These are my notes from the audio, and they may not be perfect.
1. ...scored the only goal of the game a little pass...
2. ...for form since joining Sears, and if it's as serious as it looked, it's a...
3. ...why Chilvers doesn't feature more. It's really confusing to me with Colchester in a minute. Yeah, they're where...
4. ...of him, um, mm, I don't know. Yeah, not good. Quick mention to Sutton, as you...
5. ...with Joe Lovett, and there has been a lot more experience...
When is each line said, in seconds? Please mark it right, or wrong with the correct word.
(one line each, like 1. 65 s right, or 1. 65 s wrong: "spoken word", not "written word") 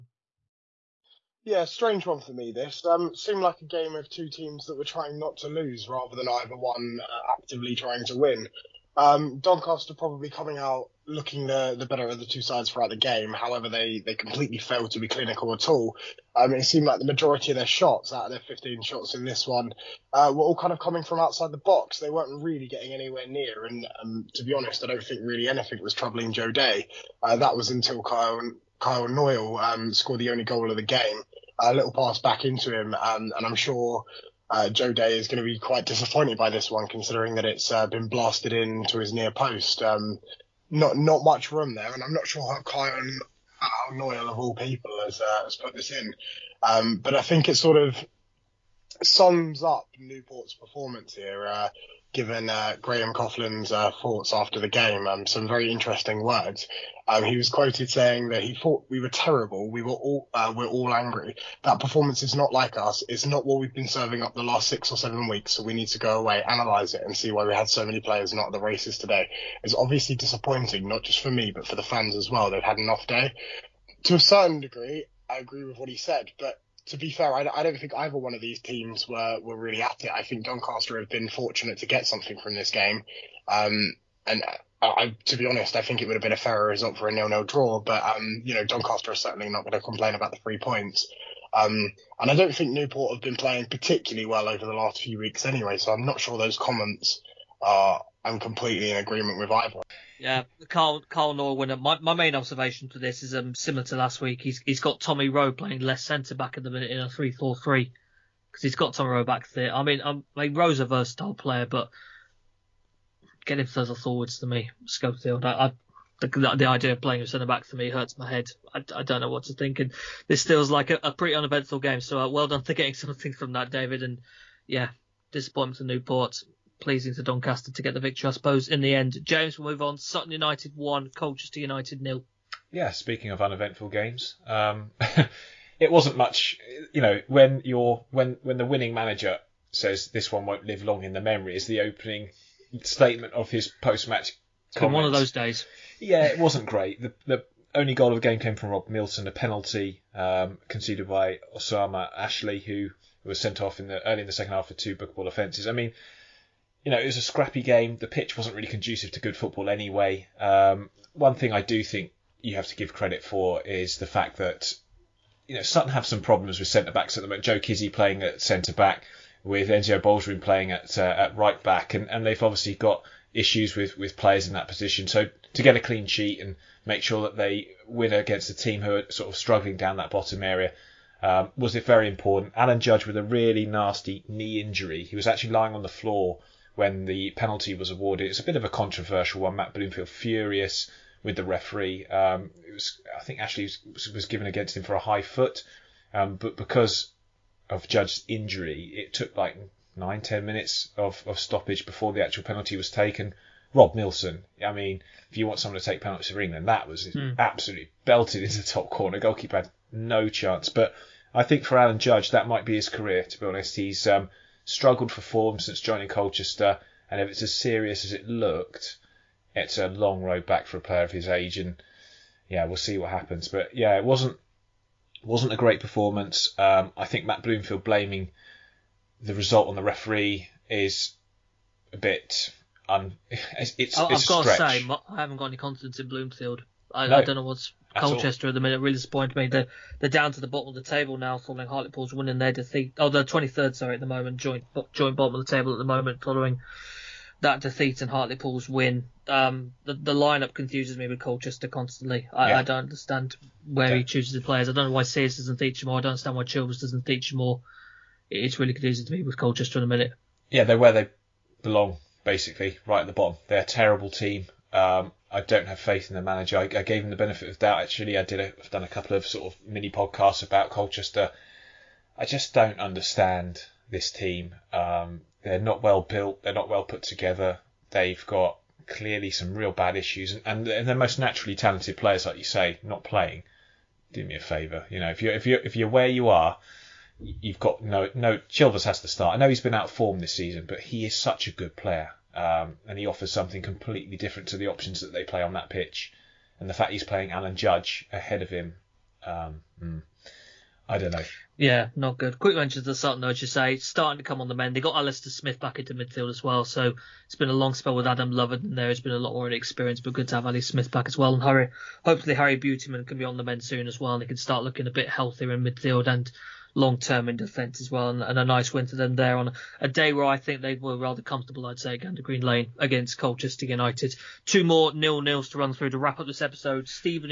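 1. 29 s right
2. 215 s wrong: "Colchester", not "Sears"
3. 256 s right
4. 298 s right
5. 307 s wrong: "Adam", not "Joe".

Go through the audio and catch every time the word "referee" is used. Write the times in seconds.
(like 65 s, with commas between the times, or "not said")
191 s, 229 s.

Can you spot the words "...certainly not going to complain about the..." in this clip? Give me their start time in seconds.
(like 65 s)
89 s.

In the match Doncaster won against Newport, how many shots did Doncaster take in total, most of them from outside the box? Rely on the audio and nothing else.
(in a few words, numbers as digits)
15.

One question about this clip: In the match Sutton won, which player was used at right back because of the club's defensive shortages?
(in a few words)
Enzio Boldewijn.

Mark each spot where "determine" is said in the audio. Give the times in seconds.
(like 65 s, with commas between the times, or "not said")
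not said.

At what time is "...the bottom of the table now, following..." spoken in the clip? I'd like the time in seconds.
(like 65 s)
240 s.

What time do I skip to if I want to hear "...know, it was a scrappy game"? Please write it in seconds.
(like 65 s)
156 s.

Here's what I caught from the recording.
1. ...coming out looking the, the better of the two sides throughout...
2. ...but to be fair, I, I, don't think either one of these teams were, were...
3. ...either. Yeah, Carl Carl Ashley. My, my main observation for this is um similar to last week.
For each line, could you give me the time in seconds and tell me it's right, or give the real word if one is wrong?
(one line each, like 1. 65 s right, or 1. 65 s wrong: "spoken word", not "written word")
1. 10 s right
2. 76 s right
3. 99 s wrong: "Norwinner", not "Ashley".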